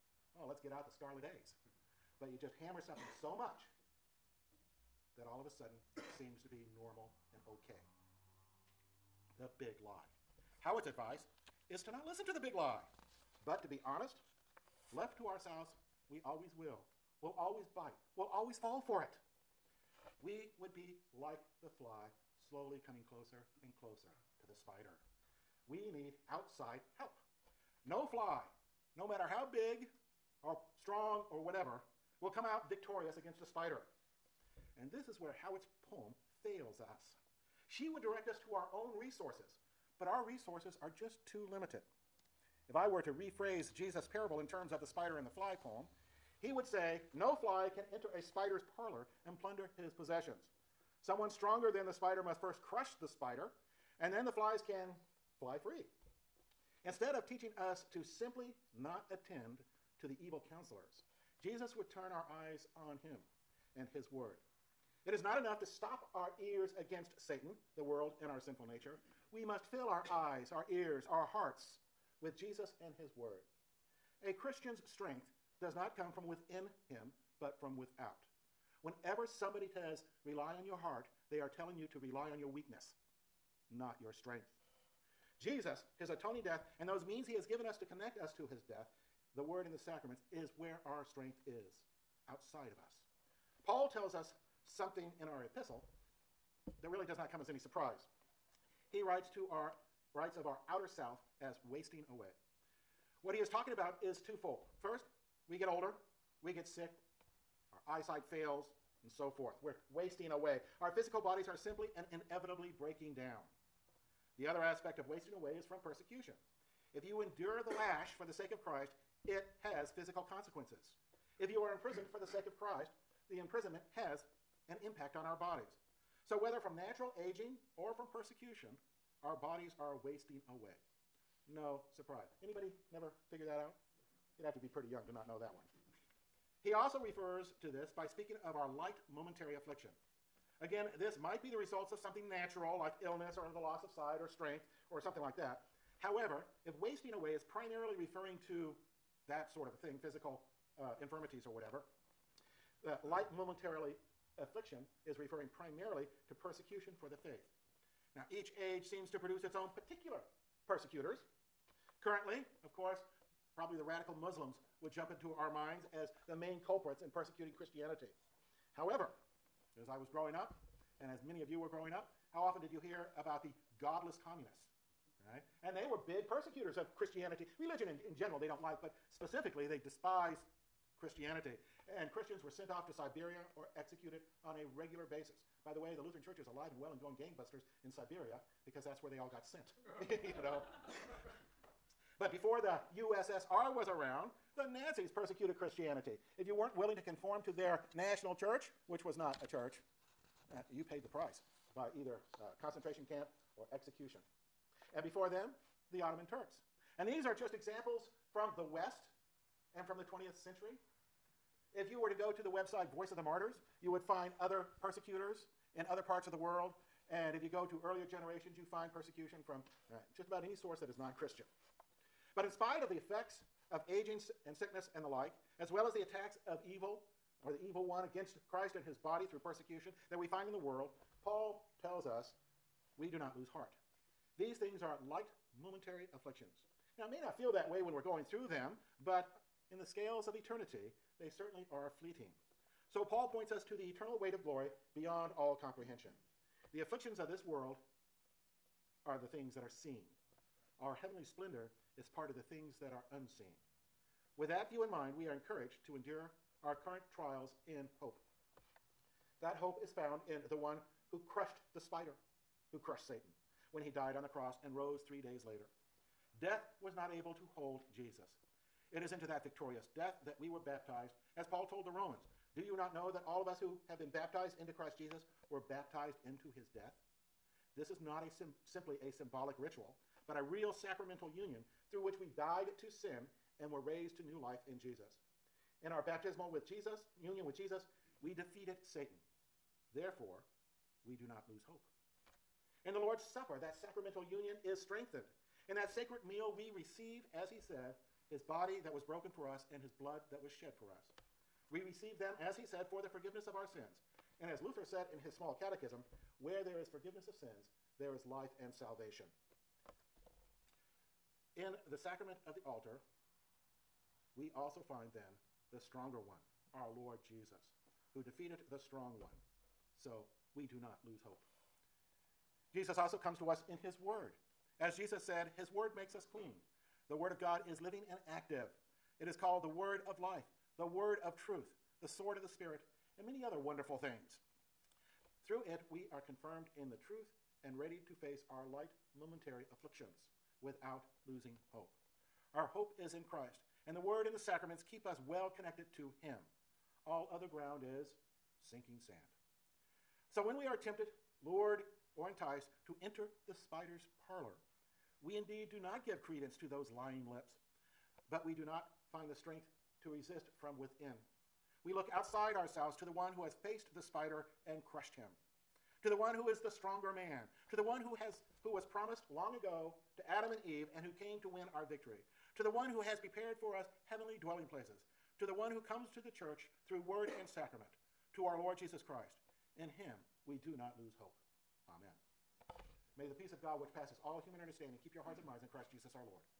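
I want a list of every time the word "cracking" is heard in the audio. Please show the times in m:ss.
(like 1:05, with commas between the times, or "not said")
not said.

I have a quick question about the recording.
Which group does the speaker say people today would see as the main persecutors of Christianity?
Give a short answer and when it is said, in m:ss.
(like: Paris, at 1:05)
radical Muslims, at 2:43.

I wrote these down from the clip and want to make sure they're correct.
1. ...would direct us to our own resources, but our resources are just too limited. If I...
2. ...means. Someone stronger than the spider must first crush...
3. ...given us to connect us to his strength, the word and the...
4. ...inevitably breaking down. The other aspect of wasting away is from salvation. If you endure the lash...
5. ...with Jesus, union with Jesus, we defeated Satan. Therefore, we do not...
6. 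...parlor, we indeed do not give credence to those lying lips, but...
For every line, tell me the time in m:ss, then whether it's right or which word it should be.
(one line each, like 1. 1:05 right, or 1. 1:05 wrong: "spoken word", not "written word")
1. 0:37 right
2. 0:49 wrong: "possessions", not "means"
3. 1:27 wrong: "death", not "strength"
4. 1:52 wrong: "persecution", not "salvation"
5. 4:46 right
6. 5:54 right.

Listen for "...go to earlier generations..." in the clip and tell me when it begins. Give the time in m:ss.
3:37.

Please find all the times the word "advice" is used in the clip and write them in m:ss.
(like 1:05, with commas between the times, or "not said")
0:10.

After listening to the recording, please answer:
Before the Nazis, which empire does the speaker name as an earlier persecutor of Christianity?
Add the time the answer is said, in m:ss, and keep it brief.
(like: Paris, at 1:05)
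Ottoman Turks, at 3:26.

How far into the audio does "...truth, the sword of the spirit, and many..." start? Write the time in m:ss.
5:31.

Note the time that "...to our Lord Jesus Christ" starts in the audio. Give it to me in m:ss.
6:18.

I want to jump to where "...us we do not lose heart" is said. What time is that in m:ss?
3:52.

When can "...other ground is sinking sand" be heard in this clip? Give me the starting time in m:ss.
5:47.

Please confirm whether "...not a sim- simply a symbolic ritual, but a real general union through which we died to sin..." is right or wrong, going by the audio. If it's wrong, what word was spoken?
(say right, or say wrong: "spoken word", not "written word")
wrong: "sacramental", not "general".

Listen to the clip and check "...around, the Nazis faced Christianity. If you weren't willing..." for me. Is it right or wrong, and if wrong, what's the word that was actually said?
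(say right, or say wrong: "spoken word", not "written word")
wrong: "persecuted", not "faced".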